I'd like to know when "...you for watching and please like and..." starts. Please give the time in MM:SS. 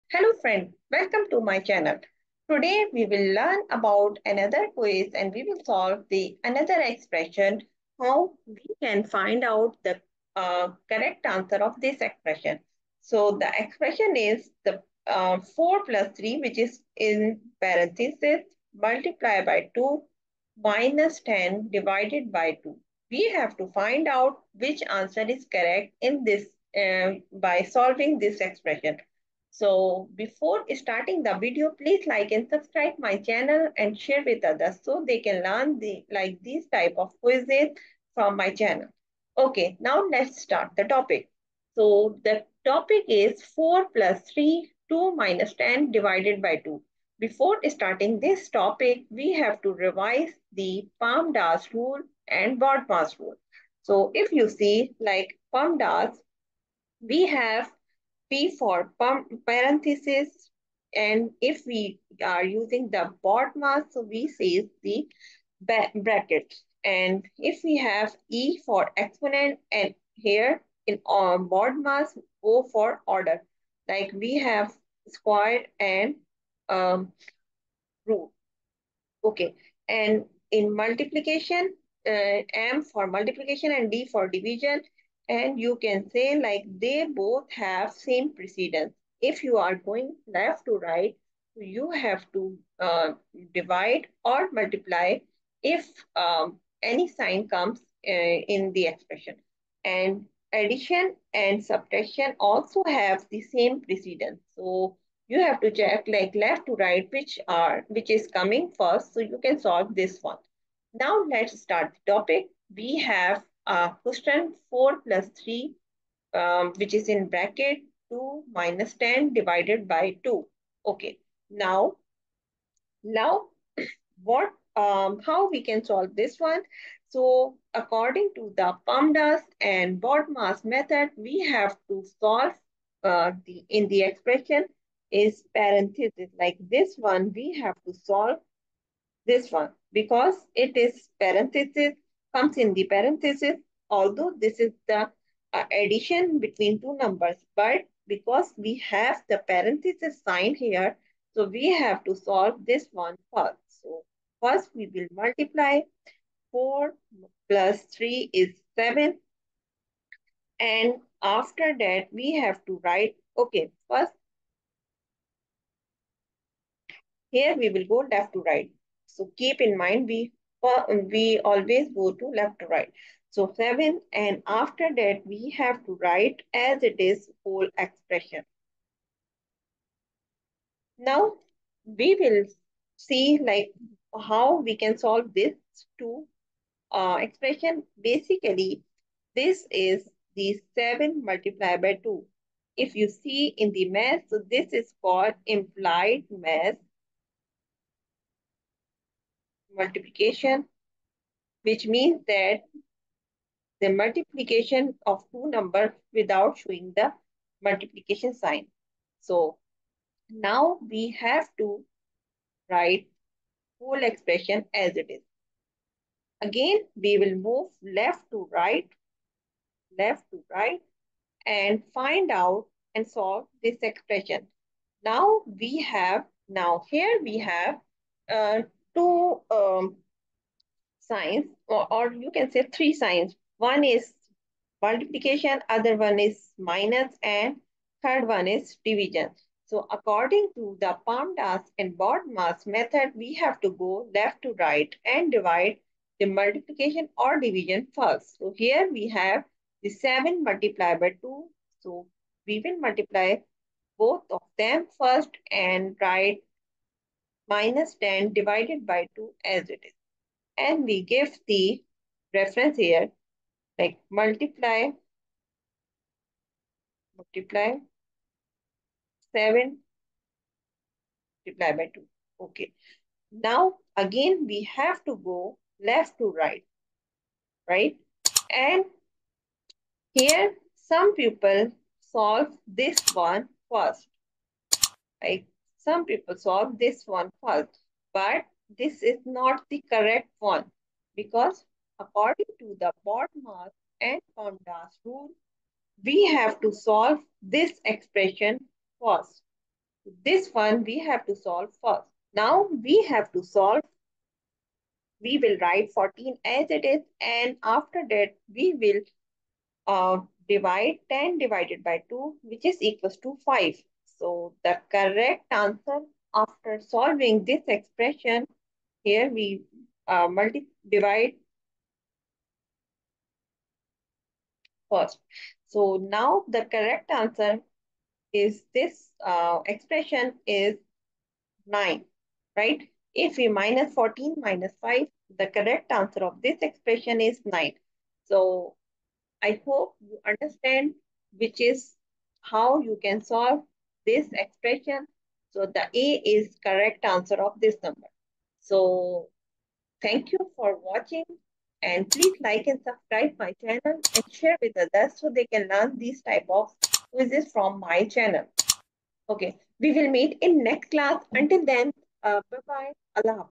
05:50.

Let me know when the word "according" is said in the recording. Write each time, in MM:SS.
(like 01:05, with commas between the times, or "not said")
02:07, 03:59, 04:51.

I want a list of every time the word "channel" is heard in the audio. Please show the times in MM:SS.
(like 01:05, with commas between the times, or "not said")
00:01, 00:33, 00:38, 05:53, 05:58.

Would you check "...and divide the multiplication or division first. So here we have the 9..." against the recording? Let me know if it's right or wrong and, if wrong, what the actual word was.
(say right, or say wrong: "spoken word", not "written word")
wrong: "7", not "9".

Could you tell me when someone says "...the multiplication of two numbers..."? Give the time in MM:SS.
03:23.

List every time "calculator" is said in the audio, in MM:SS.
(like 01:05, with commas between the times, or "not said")
not said.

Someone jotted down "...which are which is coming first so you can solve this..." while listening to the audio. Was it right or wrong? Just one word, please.
right.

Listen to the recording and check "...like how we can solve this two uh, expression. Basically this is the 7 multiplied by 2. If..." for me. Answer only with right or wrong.
right.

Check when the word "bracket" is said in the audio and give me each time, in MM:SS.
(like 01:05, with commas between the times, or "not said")
01:05, 01:57.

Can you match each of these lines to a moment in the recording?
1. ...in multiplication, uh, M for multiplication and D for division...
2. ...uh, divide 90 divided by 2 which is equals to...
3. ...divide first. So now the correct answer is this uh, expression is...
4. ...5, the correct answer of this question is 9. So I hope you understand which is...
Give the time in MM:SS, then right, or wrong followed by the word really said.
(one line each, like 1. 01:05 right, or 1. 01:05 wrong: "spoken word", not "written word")
1. 01:20 right
2. 05:09 wrong: "10", not "90"
3. 05:20 right
4. 05:34 wrong: "expression", not "question".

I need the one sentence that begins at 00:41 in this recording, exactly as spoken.
So the topic is 4 plus 3, 2 minus 10 divided by 2.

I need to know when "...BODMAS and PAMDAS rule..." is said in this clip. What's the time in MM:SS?
04:53.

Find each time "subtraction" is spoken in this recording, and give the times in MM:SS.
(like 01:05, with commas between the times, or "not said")
01:41.